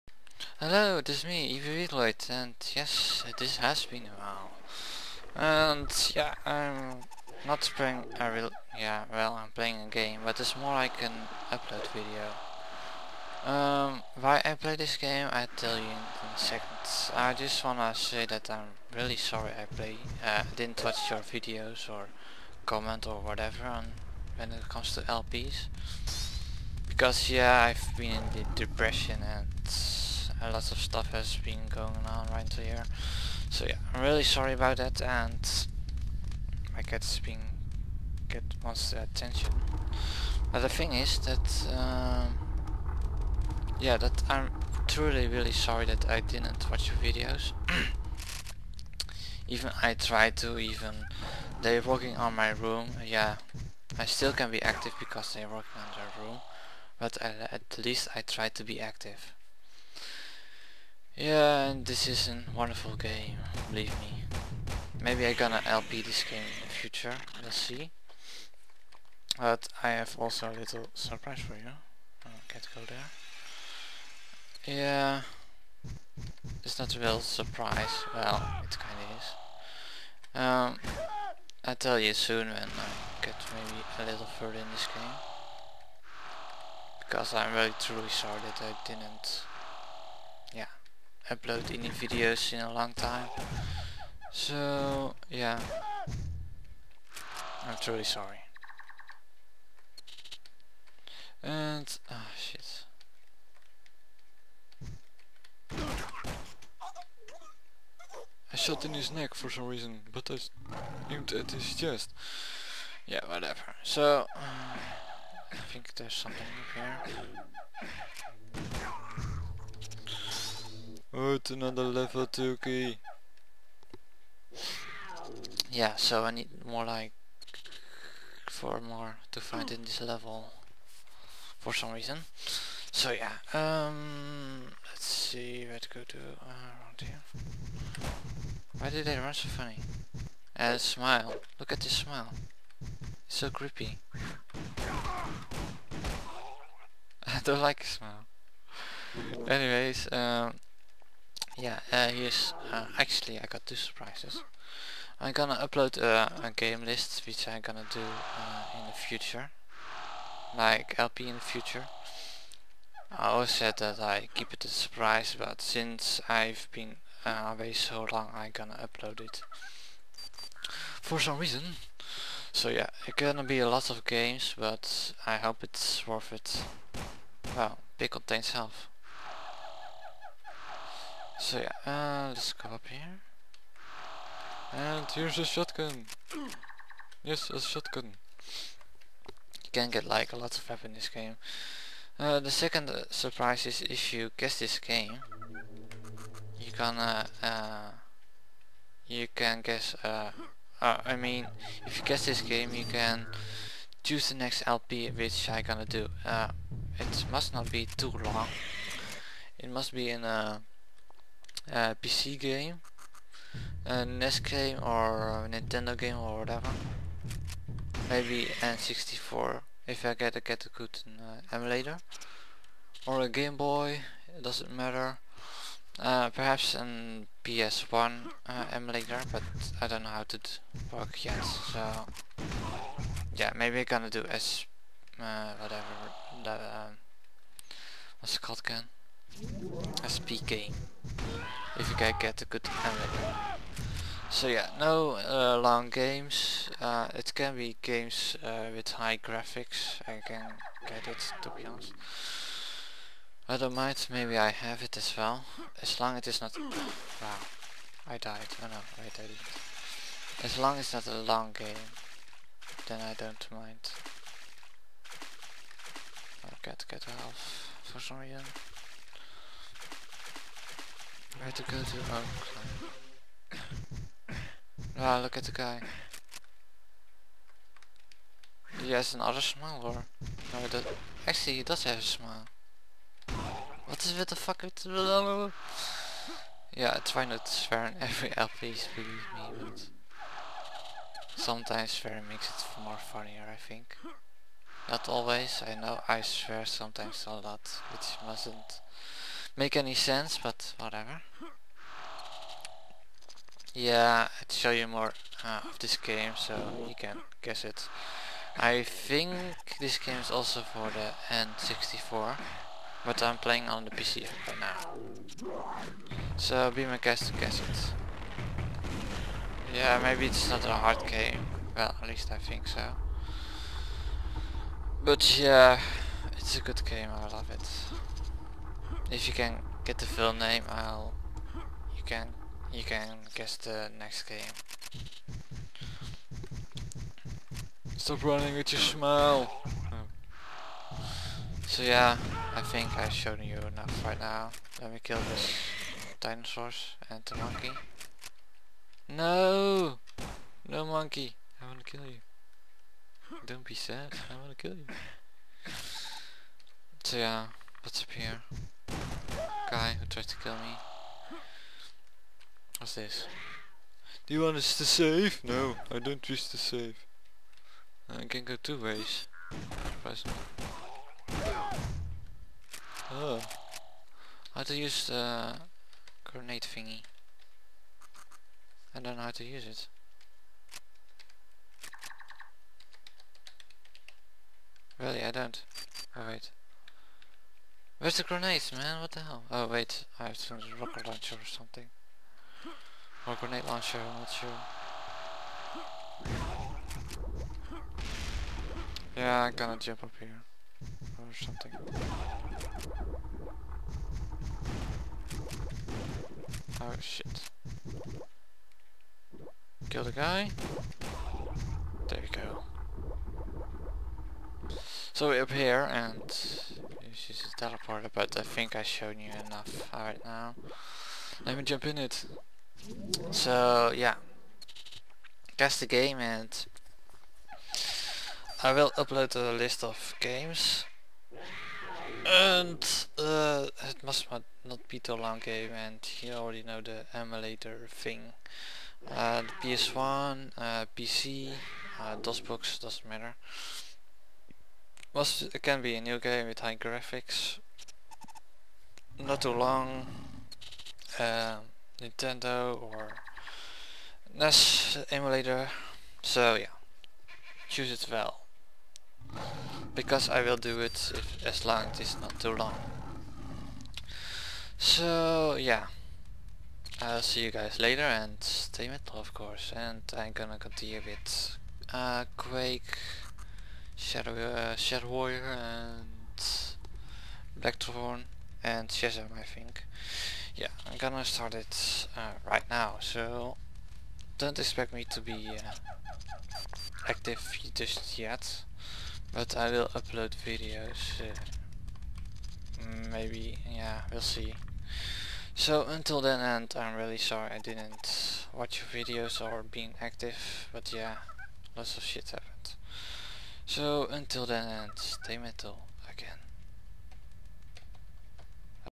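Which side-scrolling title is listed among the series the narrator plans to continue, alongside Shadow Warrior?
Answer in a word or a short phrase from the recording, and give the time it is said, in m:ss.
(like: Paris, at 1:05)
Blackthorne, at 7:57.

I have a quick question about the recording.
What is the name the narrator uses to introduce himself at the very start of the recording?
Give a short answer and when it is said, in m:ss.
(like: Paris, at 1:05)
Weavaloid, at 0:01.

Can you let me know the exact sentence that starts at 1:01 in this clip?
Yeah, and this is a wonderful game, believe me.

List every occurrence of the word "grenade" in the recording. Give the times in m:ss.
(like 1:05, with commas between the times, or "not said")
6:16, 6:28, 6:33.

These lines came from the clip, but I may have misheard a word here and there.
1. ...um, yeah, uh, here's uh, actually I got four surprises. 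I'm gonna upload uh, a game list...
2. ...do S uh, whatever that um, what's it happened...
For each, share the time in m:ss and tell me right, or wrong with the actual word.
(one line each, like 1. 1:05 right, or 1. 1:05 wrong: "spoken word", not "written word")
1. 2:30 wrong: "two", not "four"
2. 3:54 wrong: "called", not "happened".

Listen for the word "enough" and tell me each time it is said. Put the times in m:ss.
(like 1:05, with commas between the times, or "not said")
5:43, 6:59.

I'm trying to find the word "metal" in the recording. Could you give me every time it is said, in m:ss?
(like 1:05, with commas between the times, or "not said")
7:48, 8:25.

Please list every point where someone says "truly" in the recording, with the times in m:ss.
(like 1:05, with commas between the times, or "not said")
0:44, 1:27, 1:37.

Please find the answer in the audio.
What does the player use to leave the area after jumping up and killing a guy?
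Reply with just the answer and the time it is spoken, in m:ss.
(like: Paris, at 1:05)
teleporter, at 6:57.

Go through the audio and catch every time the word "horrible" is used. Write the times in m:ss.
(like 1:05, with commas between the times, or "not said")
not said.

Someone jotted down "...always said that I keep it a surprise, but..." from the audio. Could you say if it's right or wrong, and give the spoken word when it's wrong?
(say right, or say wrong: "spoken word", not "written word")
right.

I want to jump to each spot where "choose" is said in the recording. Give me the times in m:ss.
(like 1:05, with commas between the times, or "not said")
3:24, 7:37.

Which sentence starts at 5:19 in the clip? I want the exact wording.
Yeah, maybe it's not a hard game.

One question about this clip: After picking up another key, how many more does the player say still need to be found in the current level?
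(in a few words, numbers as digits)
4.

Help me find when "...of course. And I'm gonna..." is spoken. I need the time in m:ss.
7:49.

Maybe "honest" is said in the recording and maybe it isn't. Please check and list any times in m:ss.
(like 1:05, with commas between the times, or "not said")
4:11.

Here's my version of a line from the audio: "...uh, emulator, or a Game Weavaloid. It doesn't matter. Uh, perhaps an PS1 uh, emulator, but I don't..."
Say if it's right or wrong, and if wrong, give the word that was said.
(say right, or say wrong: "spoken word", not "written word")
wrong: "Boy", not "Weavaloid".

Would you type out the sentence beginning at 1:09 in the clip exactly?
But I have also a little surprise for you.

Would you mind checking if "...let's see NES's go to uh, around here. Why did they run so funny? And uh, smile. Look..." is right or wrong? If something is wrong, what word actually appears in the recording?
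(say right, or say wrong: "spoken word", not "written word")
wrong: "Let", not "NES".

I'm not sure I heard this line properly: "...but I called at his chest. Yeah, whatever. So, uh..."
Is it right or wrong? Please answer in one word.
wrong.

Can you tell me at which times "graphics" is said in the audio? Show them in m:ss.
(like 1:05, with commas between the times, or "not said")
4:09, 7:26.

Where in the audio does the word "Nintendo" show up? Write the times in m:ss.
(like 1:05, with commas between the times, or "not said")
3:35, 7:31.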